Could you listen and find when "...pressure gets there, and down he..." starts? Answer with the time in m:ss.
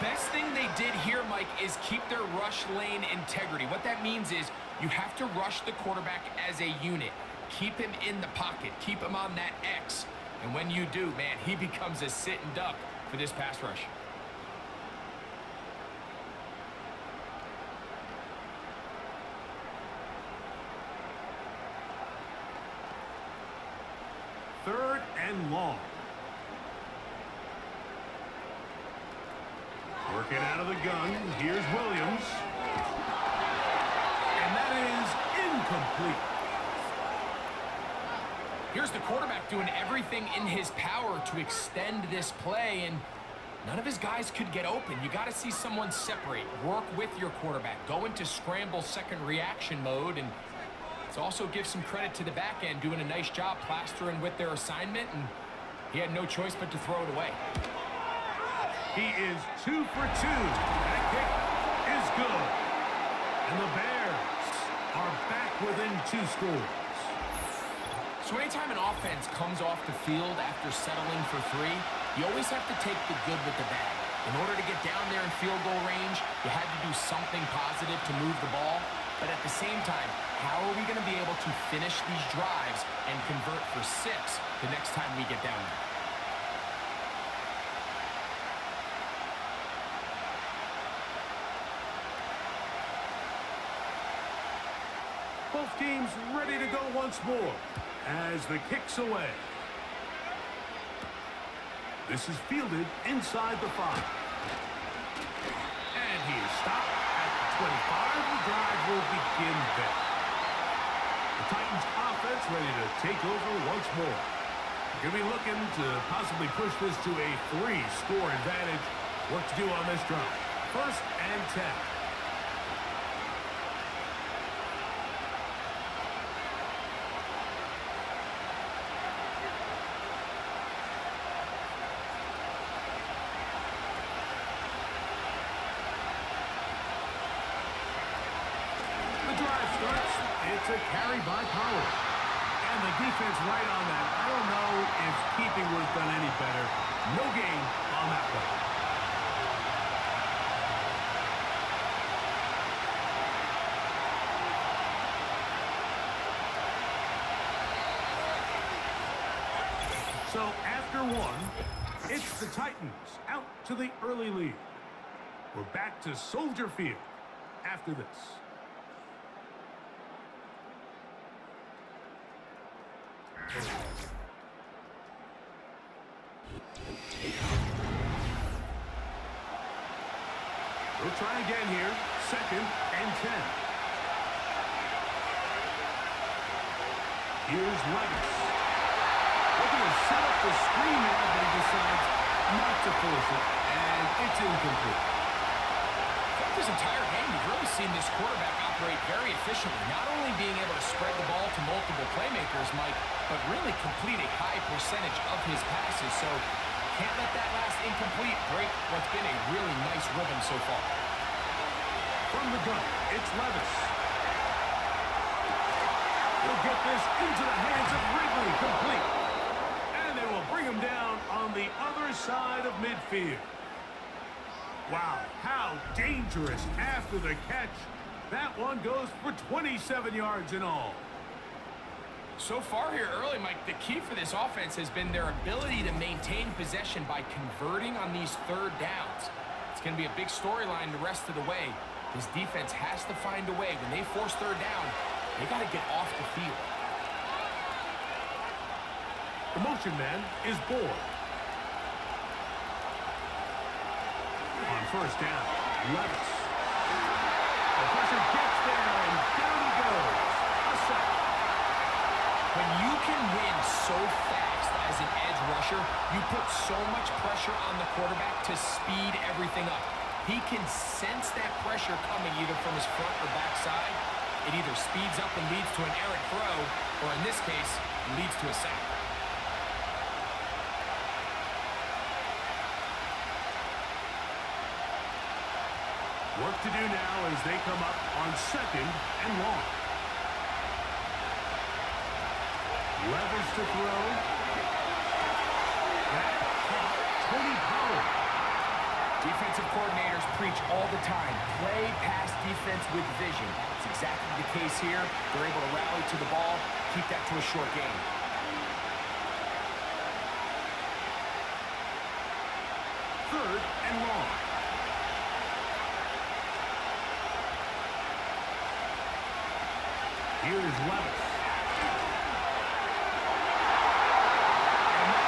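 4:17.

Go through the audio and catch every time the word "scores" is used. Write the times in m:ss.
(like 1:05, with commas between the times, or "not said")
1:06, 1:57.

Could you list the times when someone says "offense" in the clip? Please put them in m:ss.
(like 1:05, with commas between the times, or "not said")
1:08, 1:52, 3:54.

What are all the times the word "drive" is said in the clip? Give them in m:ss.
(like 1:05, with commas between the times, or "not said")
1:22, 1:48, 2:00.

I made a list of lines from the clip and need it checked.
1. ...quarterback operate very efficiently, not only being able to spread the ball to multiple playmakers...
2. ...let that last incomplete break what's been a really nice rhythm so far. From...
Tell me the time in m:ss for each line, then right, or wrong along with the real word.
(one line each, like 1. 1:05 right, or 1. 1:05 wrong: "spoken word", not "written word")
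1. 3:18 right
2. 3:27 right.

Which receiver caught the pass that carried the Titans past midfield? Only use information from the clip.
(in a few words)
Ridley.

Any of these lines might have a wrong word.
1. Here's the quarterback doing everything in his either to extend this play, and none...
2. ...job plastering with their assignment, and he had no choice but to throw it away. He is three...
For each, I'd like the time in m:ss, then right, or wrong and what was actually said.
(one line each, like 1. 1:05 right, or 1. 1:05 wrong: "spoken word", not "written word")
1. 0:38 wrong: "power", not "either"
2. 0:53 wrong: "two", not "three".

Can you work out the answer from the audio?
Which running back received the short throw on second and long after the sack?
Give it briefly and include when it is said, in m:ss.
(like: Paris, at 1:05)
Tony Pollard, at 4:57.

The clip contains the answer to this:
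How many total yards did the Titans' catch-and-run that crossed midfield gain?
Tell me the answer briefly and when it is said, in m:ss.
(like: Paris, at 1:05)
27, at 3:49.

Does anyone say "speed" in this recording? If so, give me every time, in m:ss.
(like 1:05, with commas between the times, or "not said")
4:28, 4:34.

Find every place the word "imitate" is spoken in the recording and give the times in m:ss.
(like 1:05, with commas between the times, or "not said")
not said.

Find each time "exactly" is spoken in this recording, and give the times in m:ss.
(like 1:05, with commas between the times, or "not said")
5:03.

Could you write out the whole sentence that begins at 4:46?
Work to do now as they come up on second and long.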